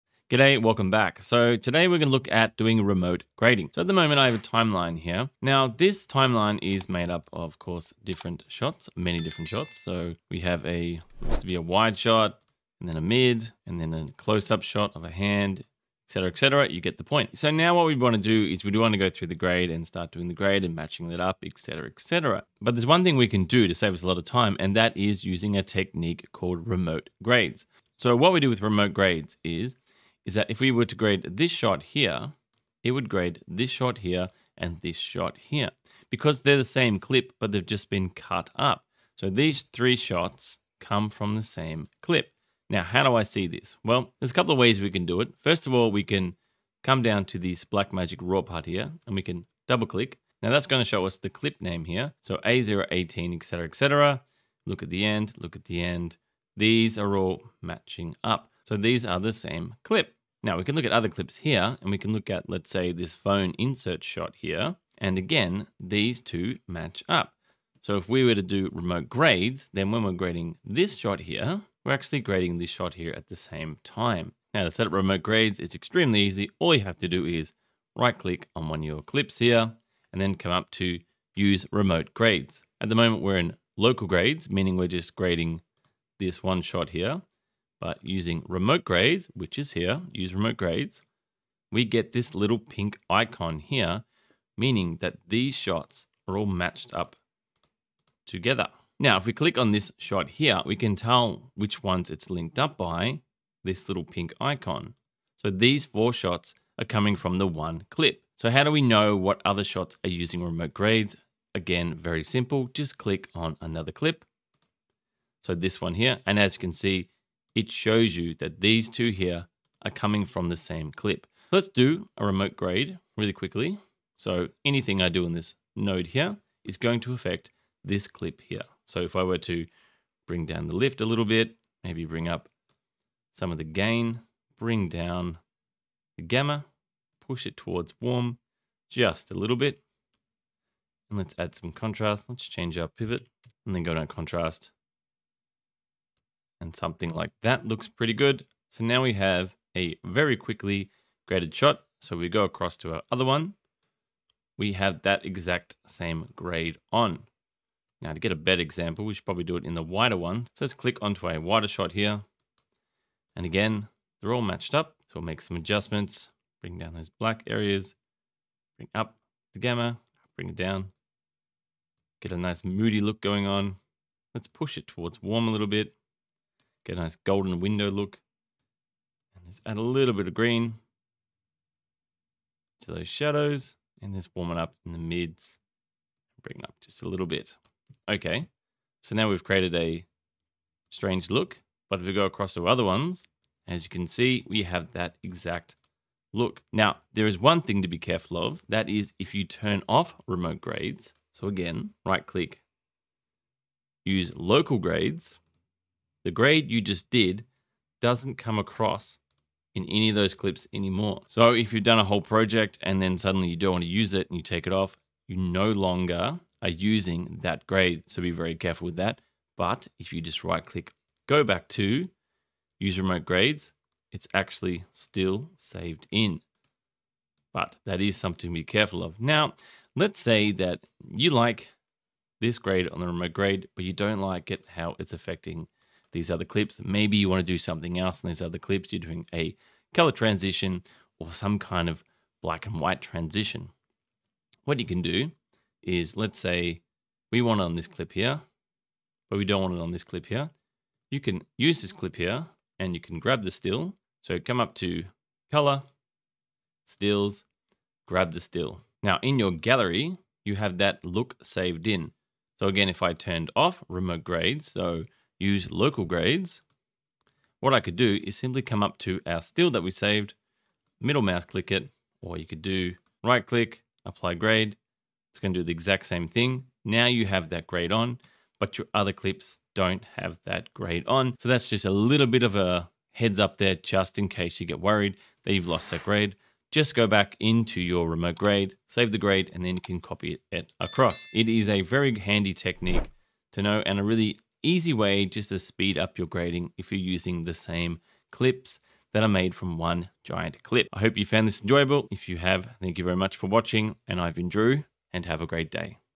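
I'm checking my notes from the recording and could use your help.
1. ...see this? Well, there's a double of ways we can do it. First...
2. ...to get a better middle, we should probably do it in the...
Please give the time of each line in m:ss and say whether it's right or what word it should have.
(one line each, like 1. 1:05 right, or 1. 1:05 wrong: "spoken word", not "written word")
1. 0:43 wrong: "couple", not "double"
2. 2:38 wrong: "example", not "middle".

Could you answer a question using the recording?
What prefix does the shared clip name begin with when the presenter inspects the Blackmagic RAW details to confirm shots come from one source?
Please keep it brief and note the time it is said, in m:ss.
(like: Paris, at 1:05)
A018, at 0:52.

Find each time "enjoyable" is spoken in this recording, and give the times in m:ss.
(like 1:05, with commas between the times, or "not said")
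5:01.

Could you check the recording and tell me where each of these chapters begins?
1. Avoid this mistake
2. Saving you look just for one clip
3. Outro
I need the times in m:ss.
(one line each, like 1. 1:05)
1. 3:16
2. 3:49
3. 4:51.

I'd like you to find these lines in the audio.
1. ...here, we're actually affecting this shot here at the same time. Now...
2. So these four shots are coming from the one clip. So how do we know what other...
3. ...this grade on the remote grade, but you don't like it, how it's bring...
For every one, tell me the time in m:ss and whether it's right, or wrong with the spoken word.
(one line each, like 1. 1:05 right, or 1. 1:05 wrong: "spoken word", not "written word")
1. 1:11 wrong: "grading", not "affecting"
2. 1:45 right
3. 3:52 wrong: "affecting", not "bring".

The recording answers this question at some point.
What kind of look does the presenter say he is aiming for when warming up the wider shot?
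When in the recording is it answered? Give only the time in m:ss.
2:57.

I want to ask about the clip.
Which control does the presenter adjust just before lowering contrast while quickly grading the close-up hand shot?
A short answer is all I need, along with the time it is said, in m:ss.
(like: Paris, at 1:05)
Pivot, at 2:22.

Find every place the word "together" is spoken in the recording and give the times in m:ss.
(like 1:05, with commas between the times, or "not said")
1:38.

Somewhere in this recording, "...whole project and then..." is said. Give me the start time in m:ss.
3:32.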